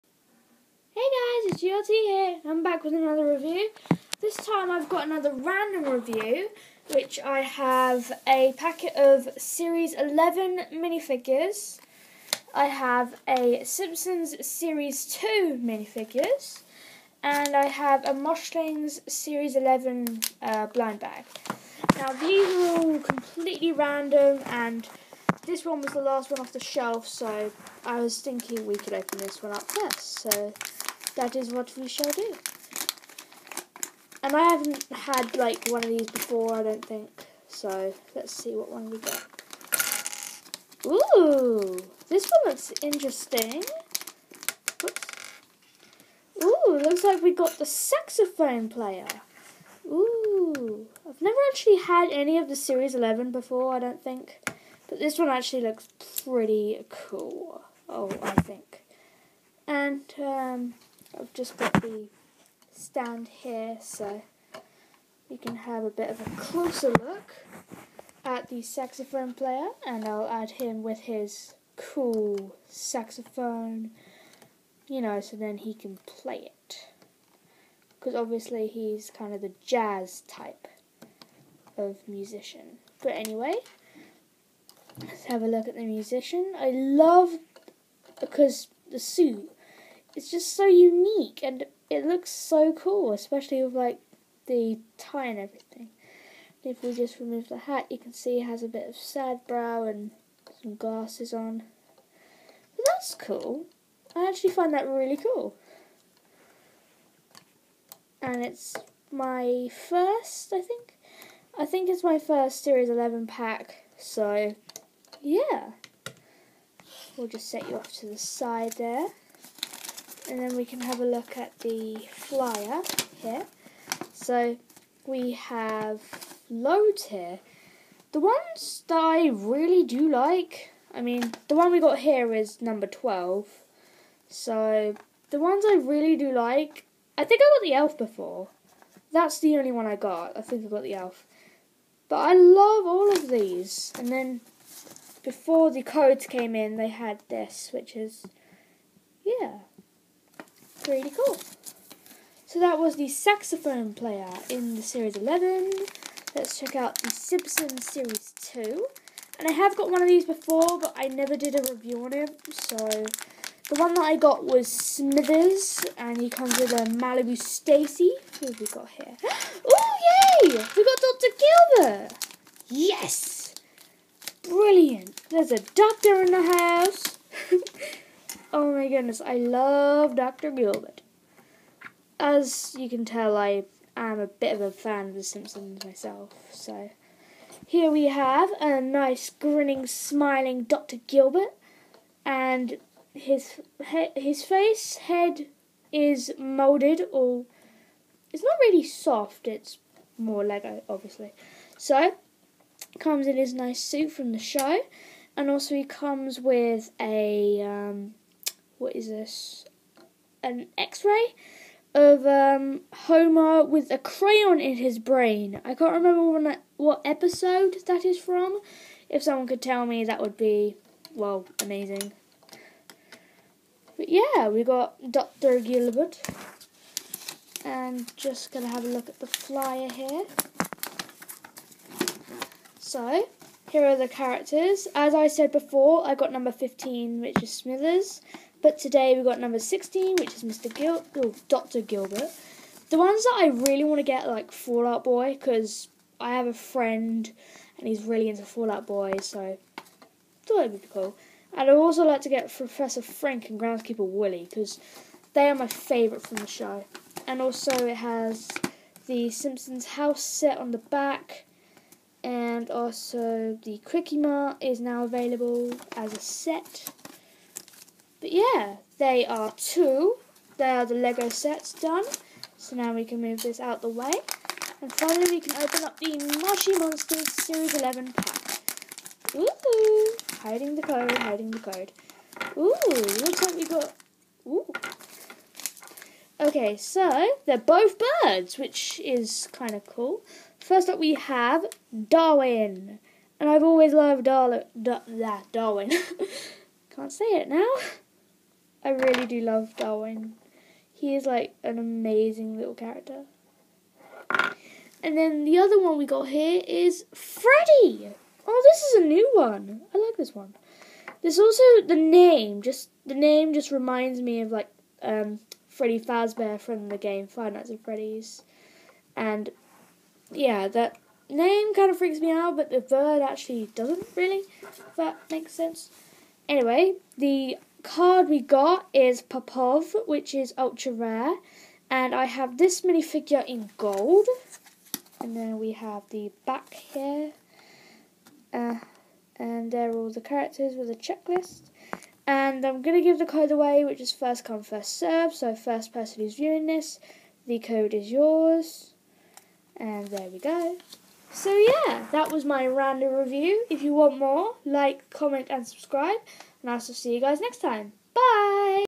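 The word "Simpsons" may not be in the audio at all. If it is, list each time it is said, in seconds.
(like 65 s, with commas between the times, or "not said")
13 s, 157 s, 185 s, 259 s.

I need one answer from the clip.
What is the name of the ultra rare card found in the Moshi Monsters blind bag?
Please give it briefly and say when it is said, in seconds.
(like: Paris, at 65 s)
Popov, at 329 s.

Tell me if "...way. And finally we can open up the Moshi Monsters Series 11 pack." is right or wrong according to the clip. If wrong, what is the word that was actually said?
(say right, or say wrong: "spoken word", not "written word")
right.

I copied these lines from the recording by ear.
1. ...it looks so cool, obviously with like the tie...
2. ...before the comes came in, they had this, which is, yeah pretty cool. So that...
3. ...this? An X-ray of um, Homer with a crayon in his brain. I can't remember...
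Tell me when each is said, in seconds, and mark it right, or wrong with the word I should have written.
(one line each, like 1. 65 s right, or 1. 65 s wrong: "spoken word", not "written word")
1. 91 s wrong: "especially", not "obviously"
2. 145 s wrong: "codes", not "comes"
3. 209 s right.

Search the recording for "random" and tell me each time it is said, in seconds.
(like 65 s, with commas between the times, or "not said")
5 s, 23 s, 352 s.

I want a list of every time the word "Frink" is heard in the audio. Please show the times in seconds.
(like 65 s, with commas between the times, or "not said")
253 s.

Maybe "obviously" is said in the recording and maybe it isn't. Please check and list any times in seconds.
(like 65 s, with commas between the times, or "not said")
78 s, 200 s.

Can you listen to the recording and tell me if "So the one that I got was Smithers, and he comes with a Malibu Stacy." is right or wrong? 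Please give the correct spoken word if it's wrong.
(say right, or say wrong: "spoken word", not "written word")
right.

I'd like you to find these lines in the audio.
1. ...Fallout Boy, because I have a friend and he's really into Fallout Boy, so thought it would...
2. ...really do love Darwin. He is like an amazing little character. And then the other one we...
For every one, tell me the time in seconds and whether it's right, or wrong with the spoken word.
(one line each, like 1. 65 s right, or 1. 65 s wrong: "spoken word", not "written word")
1. 244 s right
2. 298 s right.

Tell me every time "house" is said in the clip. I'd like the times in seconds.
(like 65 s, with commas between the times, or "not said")
176 s, 259 s.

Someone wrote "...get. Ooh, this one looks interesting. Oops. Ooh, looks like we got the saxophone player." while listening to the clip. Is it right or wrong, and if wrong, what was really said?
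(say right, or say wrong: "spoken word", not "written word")
right.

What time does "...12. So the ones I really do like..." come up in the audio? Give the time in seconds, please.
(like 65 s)
132 s.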